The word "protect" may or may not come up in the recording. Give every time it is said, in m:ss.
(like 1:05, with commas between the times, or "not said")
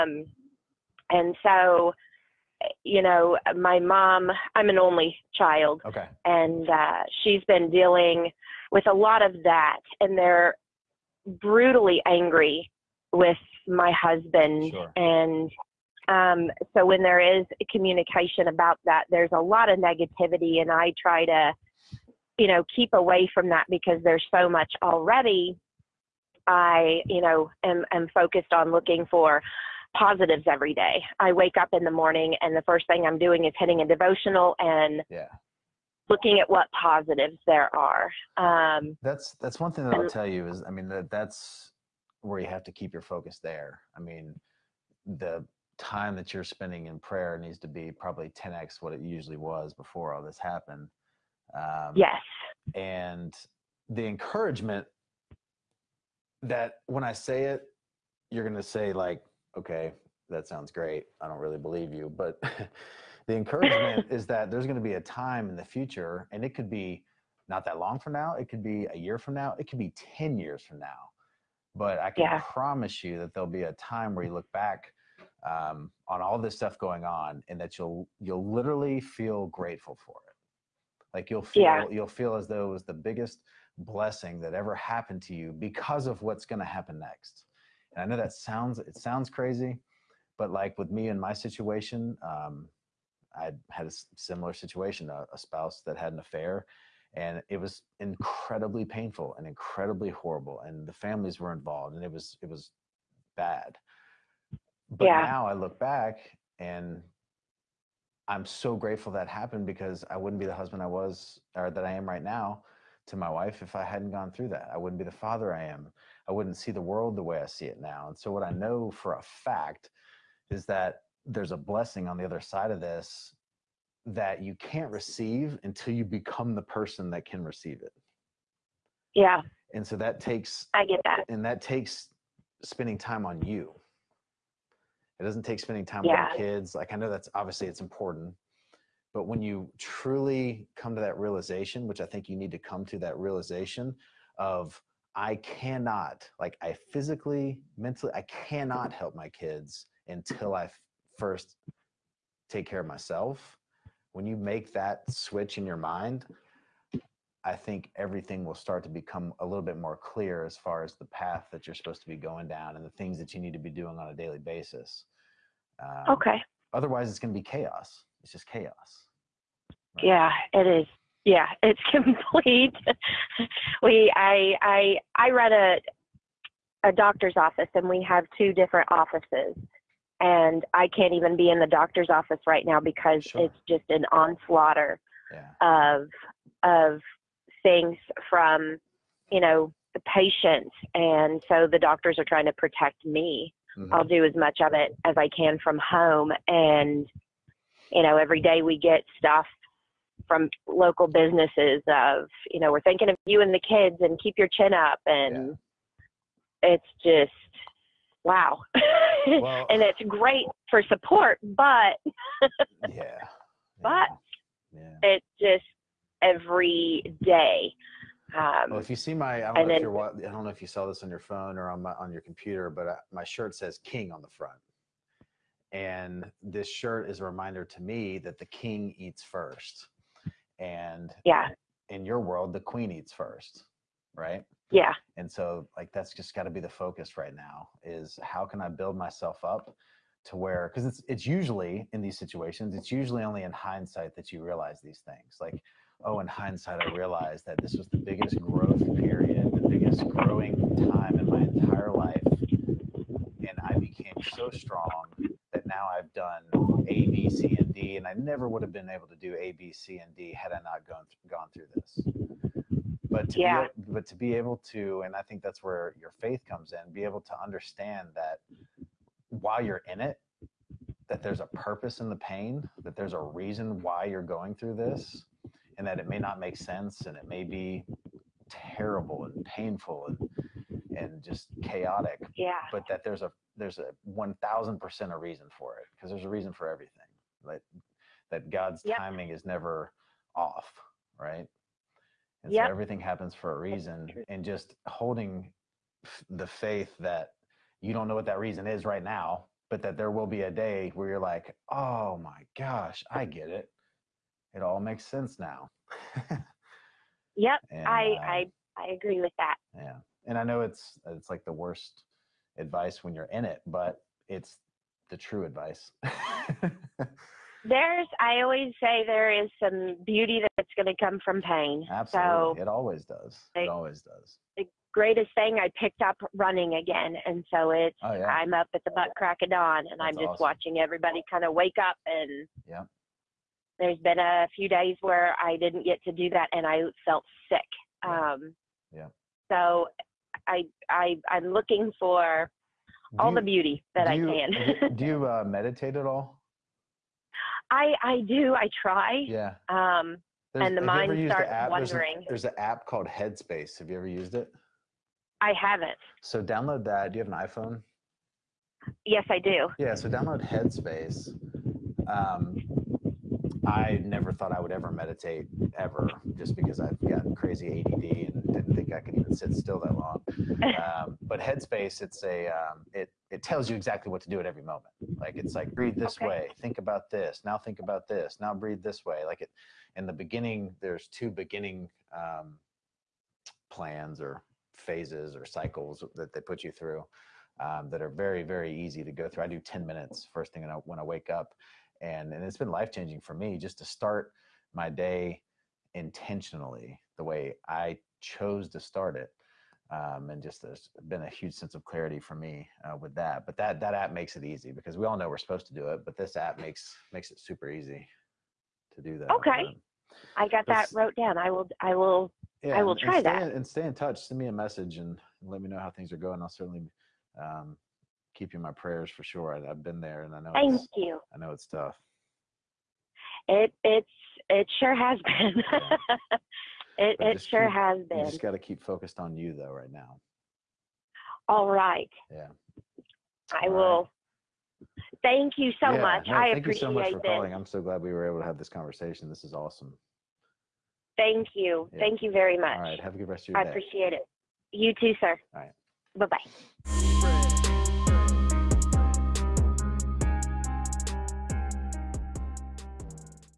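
3:12.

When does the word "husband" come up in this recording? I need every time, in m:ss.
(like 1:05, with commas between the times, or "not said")
0:13, 1:50.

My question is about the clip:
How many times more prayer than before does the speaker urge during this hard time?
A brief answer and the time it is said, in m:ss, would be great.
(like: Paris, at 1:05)
10x, at 0:48.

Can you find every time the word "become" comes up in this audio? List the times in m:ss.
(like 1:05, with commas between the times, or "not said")
2:06, 2:38.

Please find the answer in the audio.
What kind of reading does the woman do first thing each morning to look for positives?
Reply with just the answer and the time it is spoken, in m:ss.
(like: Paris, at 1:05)
A devotional, at 0:33.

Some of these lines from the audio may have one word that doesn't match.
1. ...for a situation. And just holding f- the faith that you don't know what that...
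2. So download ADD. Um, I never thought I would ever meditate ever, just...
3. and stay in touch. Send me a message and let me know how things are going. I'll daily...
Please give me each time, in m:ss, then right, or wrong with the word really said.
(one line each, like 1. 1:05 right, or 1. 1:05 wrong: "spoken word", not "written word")
1. 4:53 wrong: "reason", not "situation"
2. 5:59 wrong: "Headspace", not "ADD"
3. 6:53 wrong: "certainly", not "daily".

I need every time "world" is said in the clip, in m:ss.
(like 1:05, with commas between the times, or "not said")
1:56, 3:52.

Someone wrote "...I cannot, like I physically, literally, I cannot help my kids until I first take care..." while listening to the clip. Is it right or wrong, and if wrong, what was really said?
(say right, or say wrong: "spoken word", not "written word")
wrong: "mentally", not "literally".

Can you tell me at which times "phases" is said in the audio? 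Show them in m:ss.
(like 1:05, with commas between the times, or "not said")
6:24.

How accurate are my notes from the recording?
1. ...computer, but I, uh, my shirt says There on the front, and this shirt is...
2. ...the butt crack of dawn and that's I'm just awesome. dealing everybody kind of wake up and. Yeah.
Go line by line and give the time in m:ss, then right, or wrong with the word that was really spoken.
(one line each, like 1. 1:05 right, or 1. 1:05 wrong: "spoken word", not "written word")
1. 3:42 wrong: "King", not "There"
2. 5:28 wrong: "watching", not "dealing".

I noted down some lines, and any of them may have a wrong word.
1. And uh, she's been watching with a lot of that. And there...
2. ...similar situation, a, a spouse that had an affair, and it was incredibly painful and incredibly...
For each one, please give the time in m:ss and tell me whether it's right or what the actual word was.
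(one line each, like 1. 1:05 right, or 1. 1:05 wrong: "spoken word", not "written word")
1. 0:06 wrong: "dealing", not "watching"
2. 1:34 right.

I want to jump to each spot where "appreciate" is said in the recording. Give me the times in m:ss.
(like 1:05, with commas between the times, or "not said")
7:16, 7:23.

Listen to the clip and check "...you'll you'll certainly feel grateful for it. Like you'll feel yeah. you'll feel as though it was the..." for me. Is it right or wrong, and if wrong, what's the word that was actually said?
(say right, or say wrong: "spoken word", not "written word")
wrong: "literally", not "certainly".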